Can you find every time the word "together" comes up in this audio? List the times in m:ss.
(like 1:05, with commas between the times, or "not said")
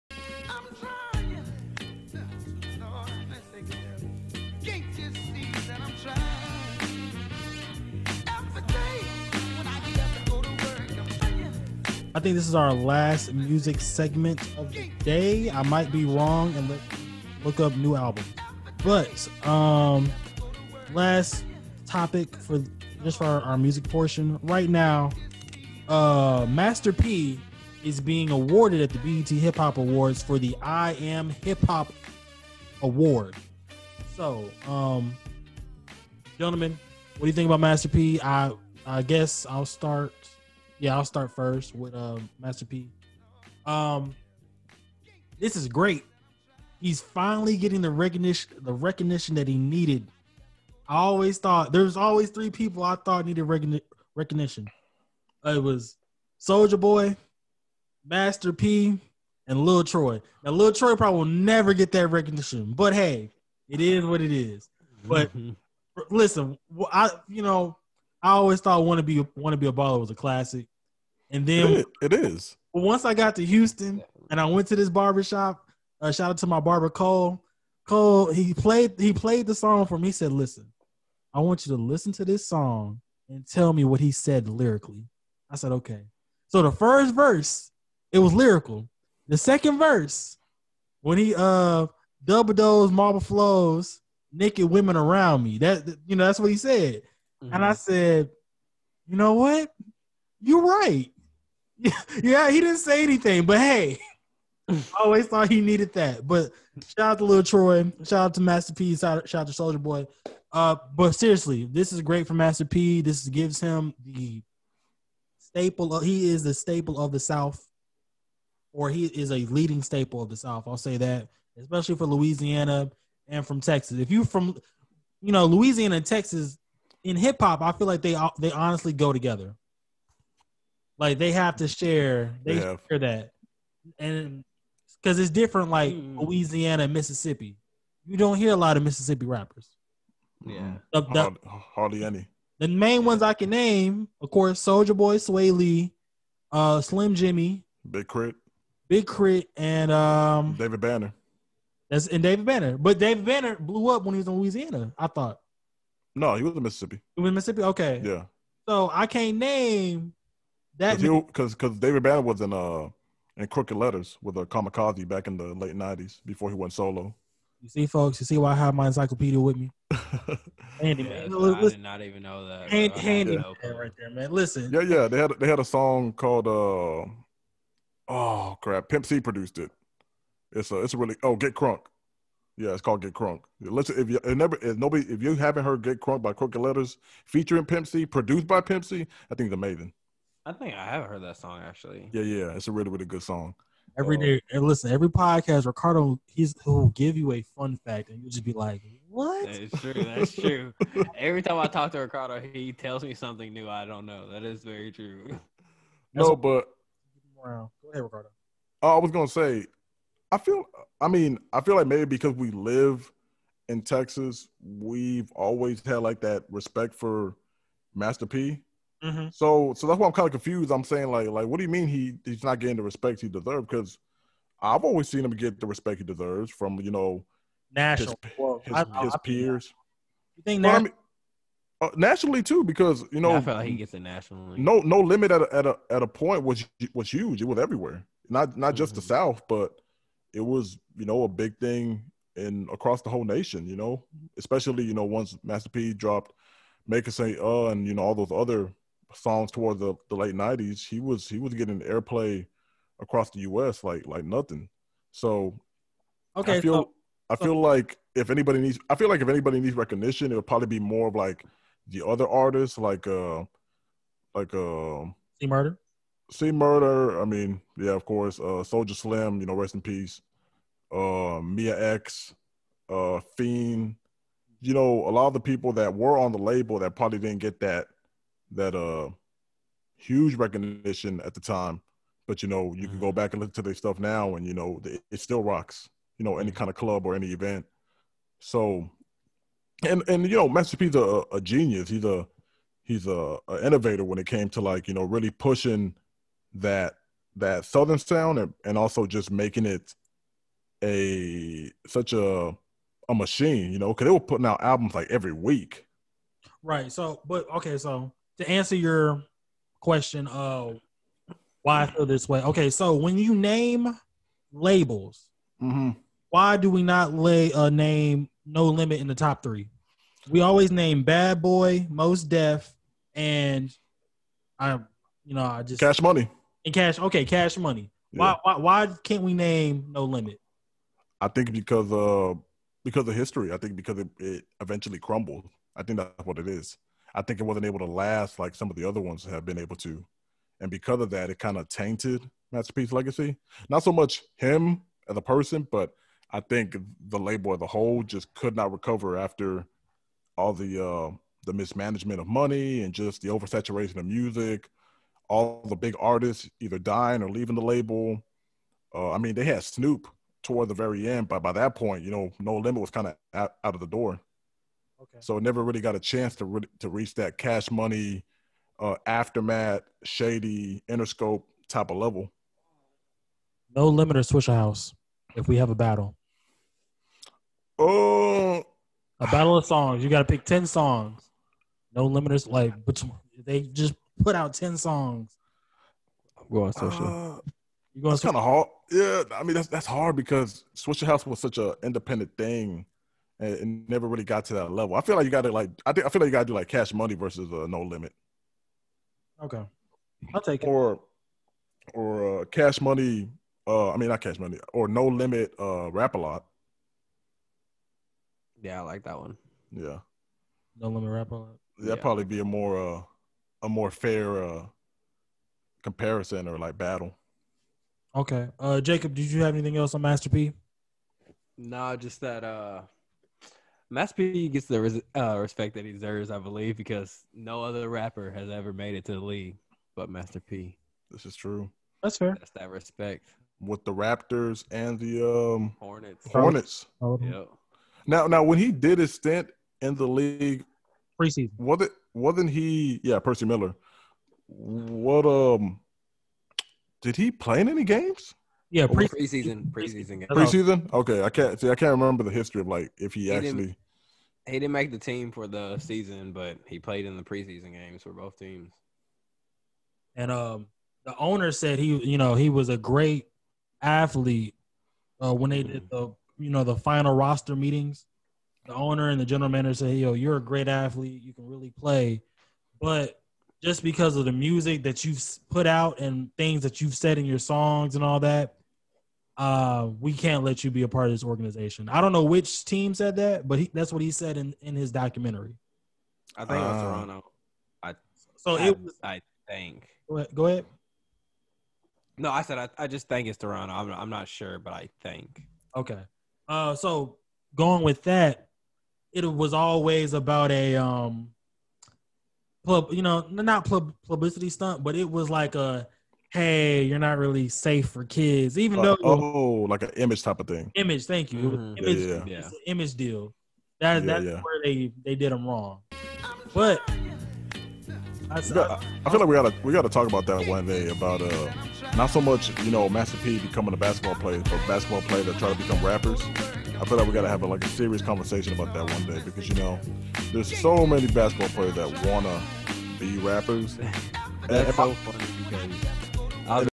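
2:09.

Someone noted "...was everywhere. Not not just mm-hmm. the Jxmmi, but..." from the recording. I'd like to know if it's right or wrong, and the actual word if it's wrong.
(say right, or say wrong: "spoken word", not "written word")
wrong: "South", not "Jxmmi".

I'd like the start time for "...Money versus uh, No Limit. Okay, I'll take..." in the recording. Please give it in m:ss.
6:36.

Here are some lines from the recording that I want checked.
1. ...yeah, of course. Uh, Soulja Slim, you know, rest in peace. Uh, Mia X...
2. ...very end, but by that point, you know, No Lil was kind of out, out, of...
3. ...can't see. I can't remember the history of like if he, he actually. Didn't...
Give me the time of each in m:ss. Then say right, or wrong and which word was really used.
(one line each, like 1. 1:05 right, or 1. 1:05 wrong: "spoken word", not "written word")
1. 4:27 right
2. 6:00 wrong: "Limit", not "Lil"
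3. 7:31 right.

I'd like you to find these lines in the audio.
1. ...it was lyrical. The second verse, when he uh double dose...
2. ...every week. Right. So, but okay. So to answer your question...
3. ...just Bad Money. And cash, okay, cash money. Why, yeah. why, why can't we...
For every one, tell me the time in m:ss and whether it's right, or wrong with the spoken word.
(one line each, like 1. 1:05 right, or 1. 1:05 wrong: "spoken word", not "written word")
1. 1:28 right
2. 5:05 right
3. 5:25 wrong: "Cash", not "Bad".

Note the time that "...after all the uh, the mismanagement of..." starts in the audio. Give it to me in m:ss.
5:49.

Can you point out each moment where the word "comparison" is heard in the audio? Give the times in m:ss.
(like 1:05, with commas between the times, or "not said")
6:55.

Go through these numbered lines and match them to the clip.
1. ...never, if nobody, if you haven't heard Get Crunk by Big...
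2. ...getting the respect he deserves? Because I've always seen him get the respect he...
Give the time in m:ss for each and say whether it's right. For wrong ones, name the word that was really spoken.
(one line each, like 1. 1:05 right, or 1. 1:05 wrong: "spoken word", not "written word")
1. 3:04 wrong: "Crooked", not "Big"
2. 3:42 right.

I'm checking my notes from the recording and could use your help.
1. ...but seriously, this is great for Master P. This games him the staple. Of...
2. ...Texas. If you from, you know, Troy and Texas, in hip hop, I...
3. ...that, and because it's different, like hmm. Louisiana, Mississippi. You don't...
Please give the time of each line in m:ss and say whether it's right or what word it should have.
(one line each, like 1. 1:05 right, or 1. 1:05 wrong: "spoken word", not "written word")
1. 1:50 wrong: "gives", not "games"
2. 2:03 wrong: "Louisiana", not "Troy"
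3. 2:12 right.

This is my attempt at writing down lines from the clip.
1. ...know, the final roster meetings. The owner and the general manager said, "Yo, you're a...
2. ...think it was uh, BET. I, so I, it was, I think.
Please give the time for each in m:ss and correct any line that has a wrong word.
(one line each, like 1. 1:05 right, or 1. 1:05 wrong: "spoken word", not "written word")
1. 7:46 right
2. 8:06 wrong: "Toronto", not "BET".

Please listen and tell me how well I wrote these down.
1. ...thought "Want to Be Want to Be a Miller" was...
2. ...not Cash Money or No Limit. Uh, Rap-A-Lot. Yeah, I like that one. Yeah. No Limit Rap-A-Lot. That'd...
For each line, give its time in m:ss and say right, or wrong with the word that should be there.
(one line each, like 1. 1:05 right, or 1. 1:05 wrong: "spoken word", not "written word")
1. 1:08 wrong: "Baller", not "Miller"
2. 6:44 right.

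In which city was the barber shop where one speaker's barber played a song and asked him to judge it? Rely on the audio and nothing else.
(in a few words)
Houston.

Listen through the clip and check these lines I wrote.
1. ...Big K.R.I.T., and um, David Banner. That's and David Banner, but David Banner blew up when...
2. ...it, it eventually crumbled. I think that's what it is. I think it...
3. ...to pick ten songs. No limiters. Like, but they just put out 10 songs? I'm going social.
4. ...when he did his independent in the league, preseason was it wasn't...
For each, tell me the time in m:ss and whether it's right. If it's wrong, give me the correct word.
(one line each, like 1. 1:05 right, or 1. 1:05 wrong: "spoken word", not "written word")
1. 2:28 right
2. 5:33 right
3. 6:20 right
4. 7:18 wrong: "stint", not "independent".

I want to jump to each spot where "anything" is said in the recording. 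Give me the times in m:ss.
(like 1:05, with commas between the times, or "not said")
1:43, 6:59.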